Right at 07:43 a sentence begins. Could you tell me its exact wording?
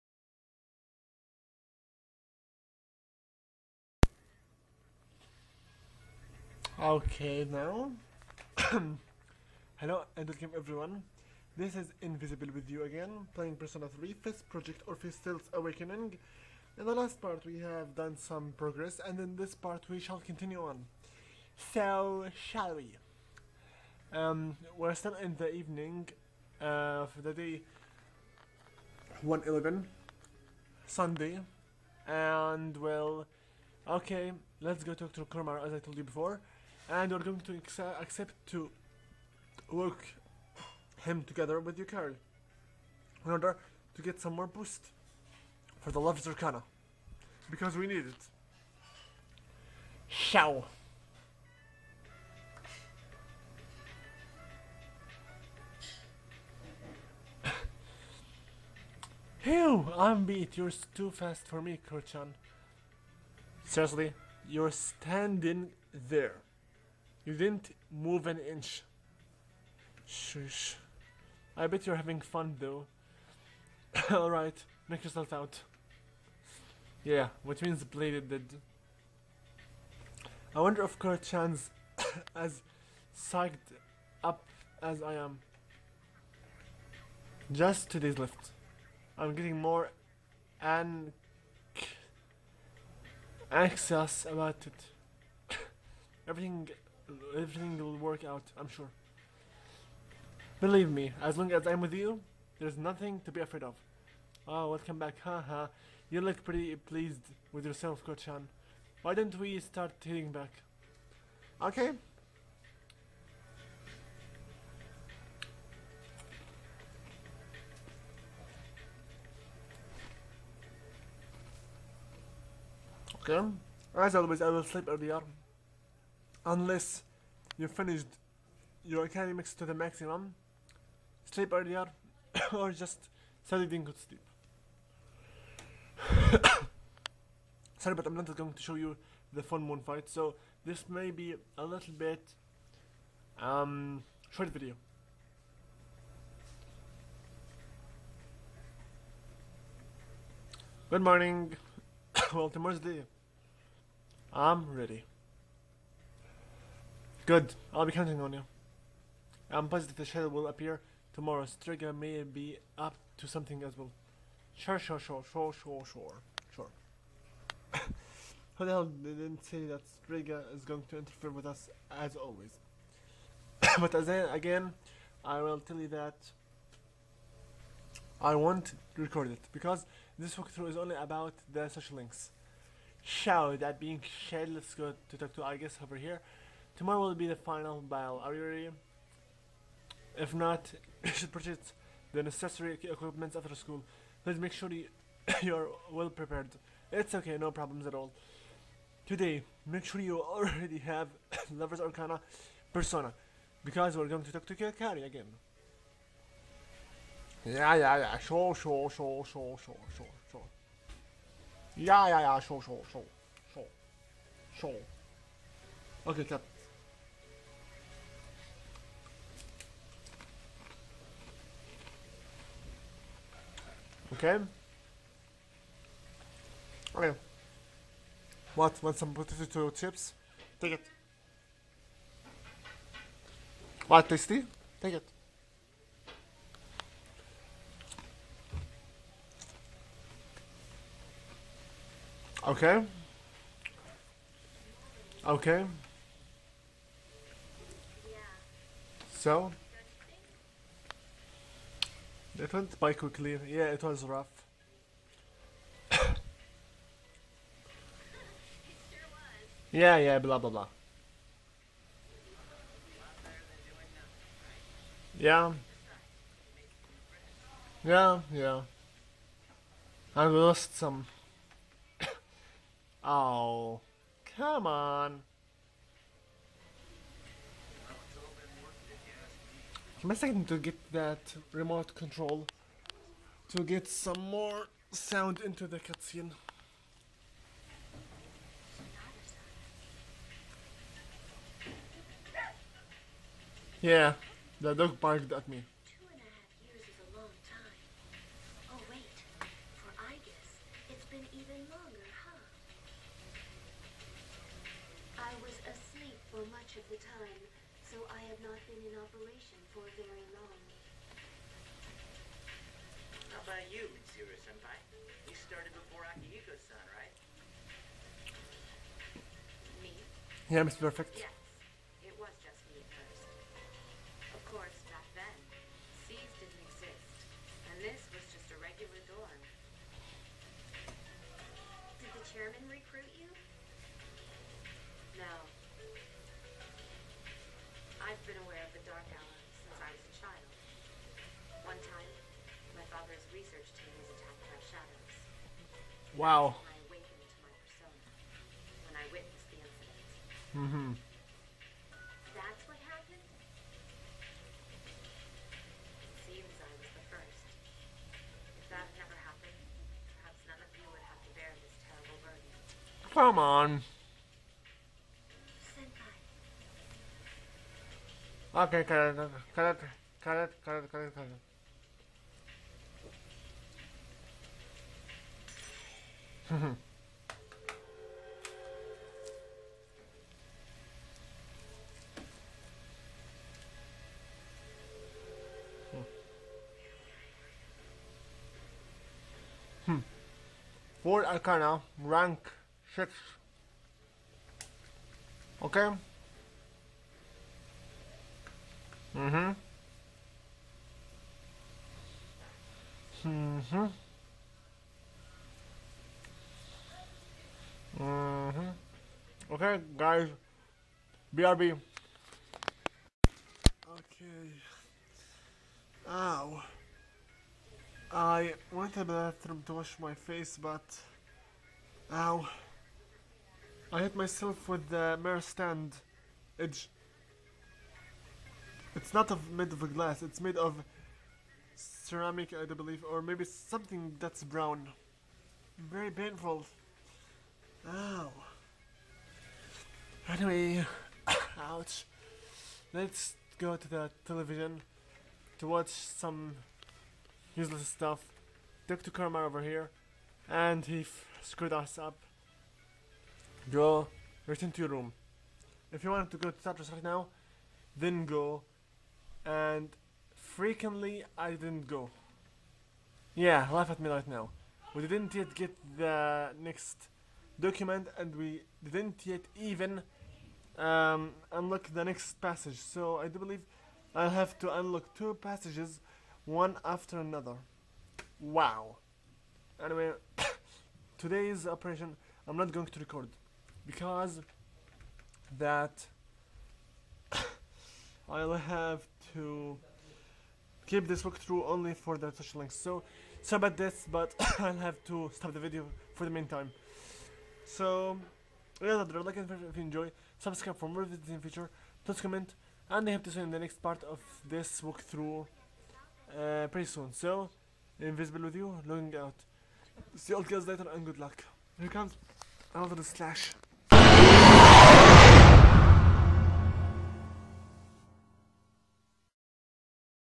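Yeah, laugh at me right now.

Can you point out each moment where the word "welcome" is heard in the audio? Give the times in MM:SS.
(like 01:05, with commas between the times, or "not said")
00:10, 01:44.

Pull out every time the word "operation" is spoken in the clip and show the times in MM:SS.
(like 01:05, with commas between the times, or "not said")
05:08, 08:01.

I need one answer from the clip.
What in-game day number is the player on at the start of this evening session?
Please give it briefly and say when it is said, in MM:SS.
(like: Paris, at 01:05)
111, at 00:27.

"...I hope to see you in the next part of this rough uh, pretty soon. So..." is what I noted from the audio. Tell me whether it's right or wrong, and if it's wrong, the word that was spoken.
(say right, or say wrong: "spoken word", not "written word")
wrong: "walkthrough", not "rough".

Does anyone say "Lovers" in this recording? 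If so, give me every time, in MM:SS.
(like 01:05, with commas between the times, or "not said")
00:45, 03:21.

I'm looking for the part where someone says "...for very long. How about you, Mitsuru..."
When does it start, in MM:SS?
05:09.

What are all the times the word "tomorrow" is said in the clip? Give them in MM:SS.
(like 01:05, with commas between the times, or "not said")
02:32, 02:41, 03:06.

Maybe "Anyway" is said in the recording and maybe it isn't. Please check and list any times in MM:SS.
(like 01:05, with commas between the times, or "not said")
07:20, 07:59.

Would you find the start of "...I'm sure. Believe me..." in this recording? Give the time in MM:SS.
01:38.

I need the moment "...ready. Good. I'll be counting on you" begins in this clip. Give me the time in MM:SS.
02:34.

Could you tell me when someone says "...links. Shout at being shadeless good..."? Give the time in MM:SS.
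03:01.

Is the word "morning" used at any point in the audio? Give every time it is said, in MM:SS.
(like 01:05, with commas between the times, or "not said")
02:31.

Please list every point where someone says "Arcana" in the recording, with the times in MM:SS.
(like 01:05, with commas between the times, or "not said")
00:46, 03:21, 06:31.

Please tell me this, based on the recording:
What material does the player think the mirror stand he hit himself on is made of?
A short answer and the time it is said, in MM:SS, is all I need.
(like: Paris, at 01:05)
Ceramic, at 07:11.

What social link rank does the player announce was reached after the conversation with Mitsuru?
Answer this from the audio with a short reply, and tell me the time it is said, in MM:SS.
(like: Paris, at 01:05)
Rank 6, at 06:32.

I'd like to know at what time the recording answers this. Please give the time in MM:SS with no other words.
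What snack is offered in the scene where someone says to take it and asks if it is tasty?
03:49.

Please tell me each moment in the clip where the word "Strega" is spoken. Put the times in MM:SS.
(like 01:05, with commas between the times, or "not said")
02:41, 02:50.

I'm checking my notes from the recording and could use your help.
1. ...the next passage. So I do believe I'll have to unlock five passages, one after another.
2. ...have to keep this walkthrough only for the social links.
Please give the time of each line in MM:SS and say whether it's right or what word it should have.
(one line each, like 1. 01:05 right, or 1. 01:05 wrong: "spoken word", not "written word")
1. 07:51 wrong: "two", not "five"
2. 08:08 right.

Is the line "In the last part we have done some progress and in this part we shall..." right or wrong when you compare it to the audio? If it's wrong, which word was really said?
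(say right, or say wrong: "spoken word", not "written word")
right.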